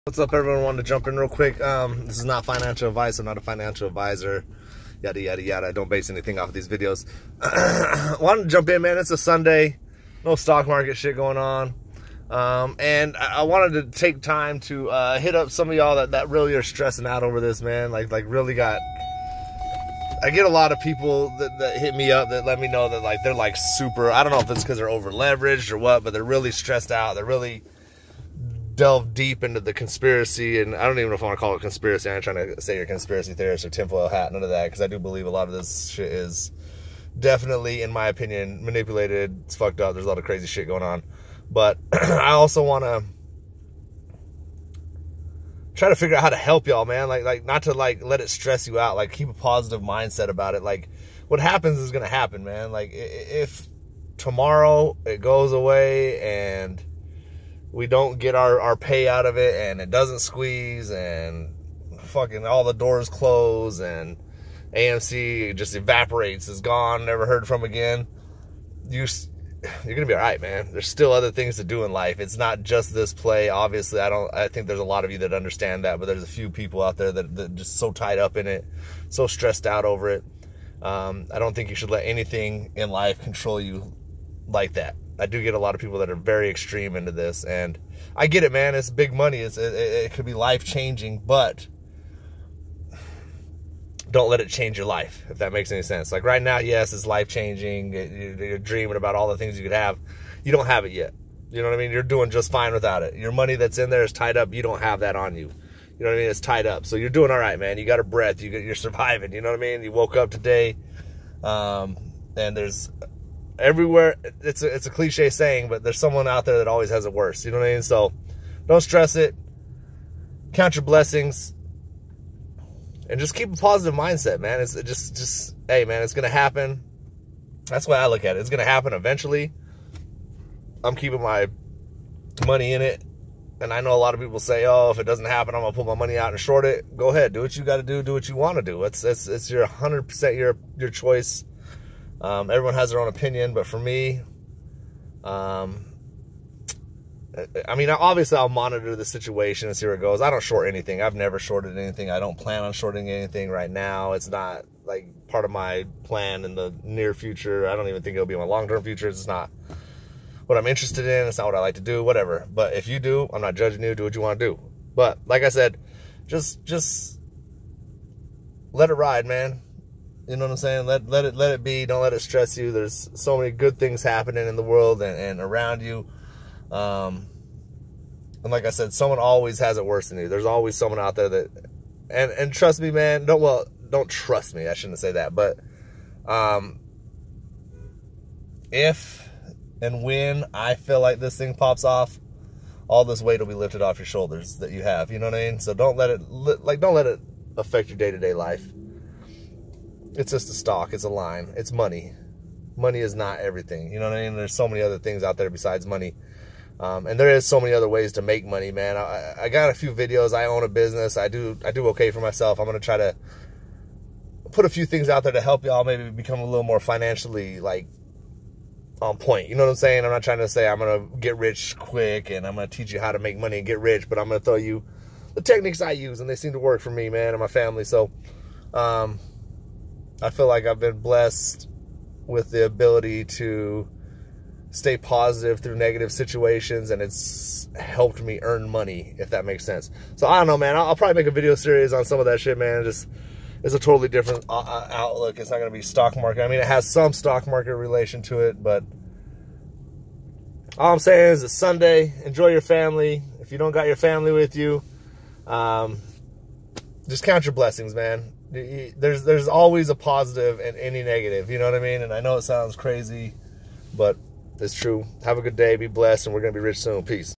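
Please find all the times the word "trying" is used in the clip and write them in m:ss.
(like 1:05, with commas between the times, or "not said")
0:32, 3:40.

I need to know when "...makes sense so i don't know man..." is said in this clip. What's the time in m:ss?
3:59.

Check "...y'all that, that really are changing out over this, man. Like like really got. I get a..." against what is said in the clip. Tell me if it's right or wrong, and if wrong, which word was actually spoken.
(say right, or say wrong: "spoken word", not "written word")
wrong: "stressing", not "changing".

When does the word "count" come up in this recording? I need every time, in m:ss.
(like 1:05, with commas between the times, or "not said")
2:00, 4:17.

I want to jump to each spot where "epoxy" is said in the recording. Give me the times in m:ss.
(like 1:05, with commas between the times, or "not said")
not said.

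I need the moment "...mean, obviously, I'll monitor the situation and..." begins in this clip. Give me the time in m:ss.
2:27.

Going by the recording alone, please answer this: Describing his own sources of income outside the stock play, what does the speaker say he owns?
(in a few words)
A business.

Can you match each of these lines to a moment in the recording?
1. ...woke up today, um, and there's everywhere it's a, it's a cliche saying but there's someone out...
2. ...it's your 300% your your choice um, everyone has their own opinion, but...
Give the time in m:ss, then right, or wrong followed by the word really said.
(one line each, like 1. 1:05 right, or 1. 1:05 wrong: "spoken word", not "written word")
1. 1:49 right
2. 2:19 wrong: "100", not "300".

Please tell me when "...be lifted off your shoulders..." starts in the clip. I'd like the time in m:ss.
3:13.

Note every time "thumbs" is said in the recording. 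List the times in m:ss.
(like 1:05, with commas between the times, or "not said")
not said.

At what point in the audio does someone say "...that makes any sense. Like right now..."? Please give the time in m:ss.
1:35.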